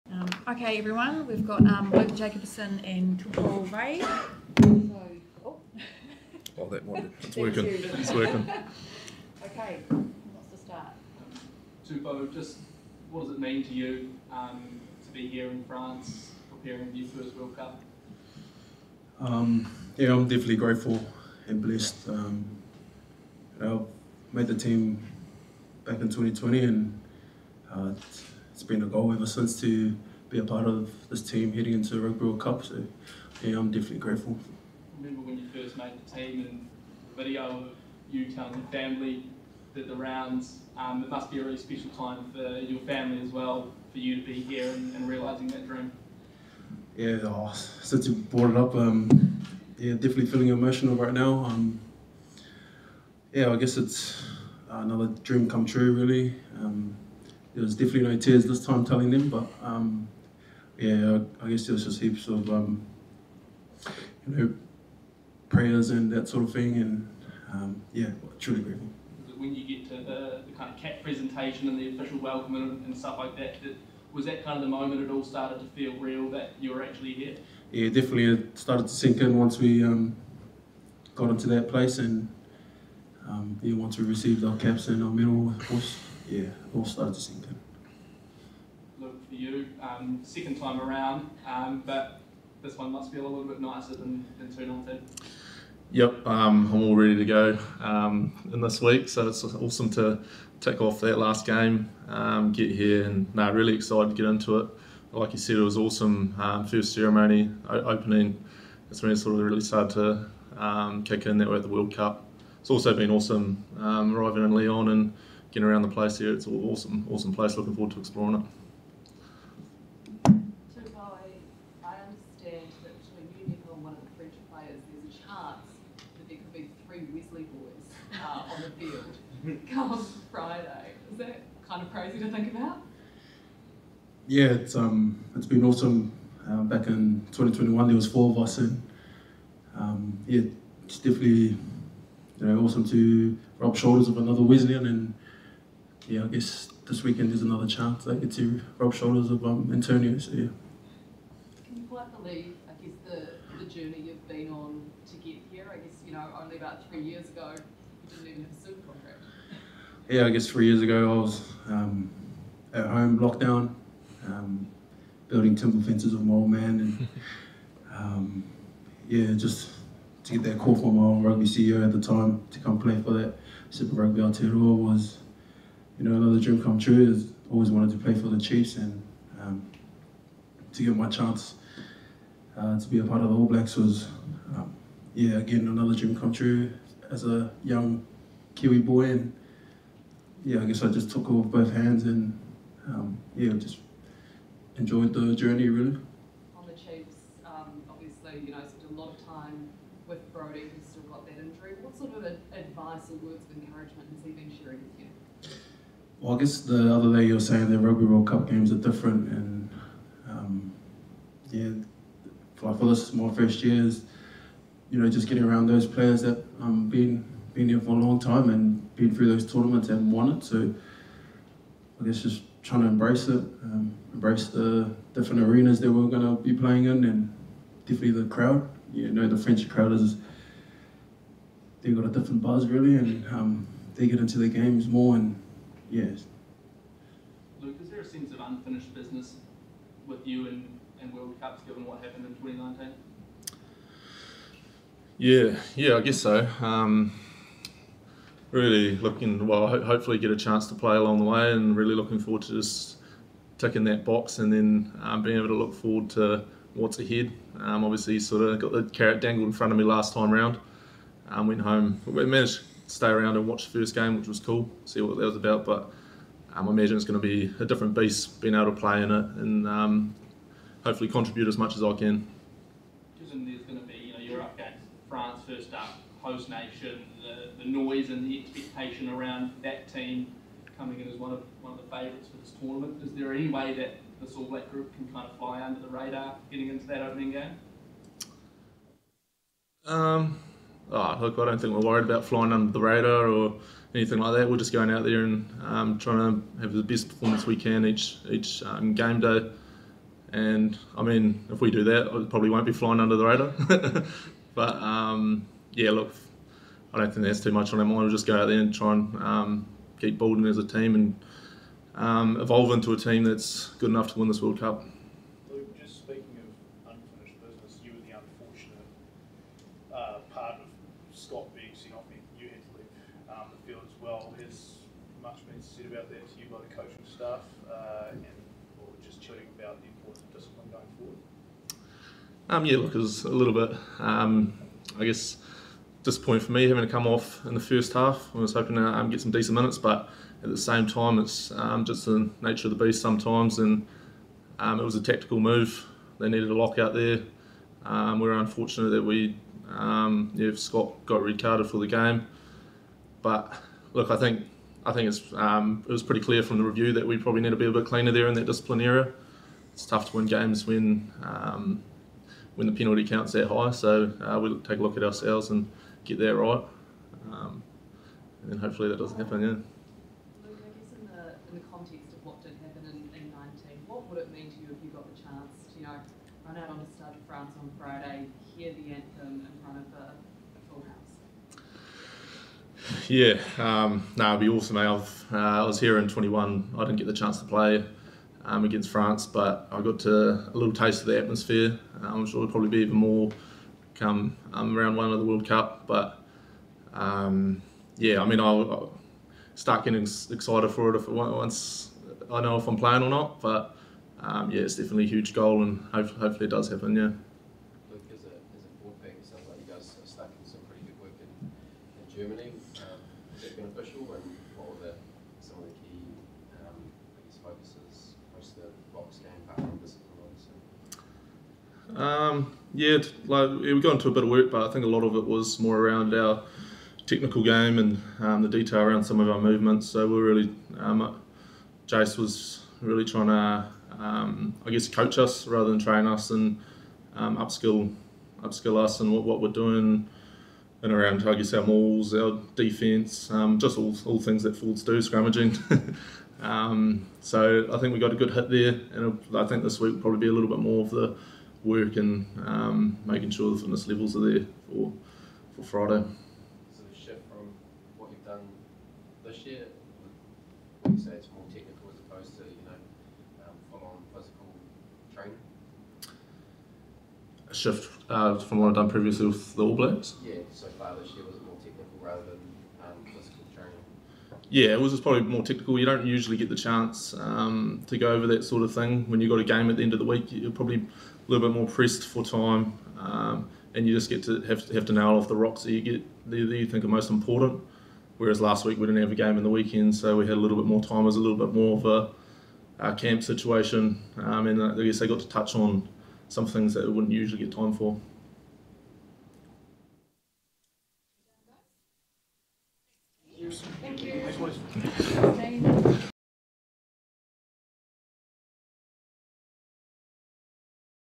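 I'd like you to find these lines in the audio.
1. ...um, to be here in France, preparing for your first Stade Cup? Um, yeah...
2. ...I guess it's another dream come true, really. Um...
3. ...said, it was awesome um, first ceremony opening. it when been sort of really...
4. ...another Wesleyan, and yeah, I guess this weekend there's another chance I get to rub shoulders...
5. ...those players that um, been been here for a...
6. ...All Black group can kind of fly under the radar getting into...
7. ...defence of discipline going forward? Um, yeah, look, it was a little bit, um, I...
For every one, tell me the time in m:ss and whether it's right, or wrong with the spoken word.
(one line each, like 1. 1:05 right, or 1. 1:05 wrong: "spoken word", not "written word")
1. 0:14 wrong: "World", not "Stade"
2. 0:53 right
3. 1:45 right
4. 2:24 right
5. 3:35 right
6. 4:44 right
7. 5:29 wrong: "importance", not "defence".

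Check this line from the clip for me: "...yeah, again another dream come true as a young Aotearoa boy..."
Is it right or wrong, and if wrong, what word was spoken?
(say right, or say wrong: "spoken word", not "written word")
wrong: "Kiwi", not "Aotearoa".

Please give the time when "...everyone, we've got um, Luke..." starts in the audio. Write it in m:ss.
0:00.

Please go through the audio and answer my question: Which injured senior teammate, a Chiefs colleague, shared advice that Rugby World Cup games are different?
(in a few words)
Brodie.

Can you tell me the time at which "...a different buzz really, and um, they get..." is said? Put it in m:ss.
3:52.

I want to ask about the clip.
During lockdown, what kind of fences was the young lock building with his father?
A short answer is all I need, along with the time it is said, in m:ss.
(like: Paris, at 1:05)
Temple fences, at 2:45.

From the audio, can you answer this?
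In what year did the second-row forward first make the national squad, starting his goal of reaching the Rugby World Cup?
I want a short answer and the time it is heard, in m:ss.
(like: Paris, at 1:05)
2020, at 0:26.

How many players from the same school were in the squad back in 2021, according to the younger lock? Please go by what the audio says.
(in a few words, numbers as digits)
4.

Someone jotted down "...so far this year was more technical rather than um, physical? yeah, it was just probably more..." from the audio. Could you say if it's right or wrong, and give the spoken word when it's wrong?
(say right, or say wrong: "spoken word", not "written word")
right.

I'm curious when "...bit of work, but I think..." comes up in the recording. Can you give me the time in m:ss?
7:04.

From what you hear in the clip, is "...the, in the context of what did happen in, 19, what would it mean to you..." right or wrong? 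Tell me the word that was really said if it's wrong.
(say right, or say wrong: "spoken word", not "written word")
right.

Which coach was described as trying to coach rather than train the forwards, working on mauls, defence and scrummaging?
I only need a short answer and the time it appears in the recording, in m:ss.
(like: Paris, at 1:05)
Jace, at 7:11.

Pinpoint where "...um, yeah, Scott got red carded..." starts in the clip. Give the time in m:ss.
5:49.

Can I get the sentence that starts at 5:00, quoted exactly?
And I mean, if we do that, it probably won't be flying under the radar.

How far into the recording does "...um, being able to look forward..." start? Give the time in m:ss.
4:15.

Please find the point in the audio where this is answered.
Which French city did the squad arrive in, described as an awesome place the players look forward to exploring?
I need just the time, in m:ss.
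1:54.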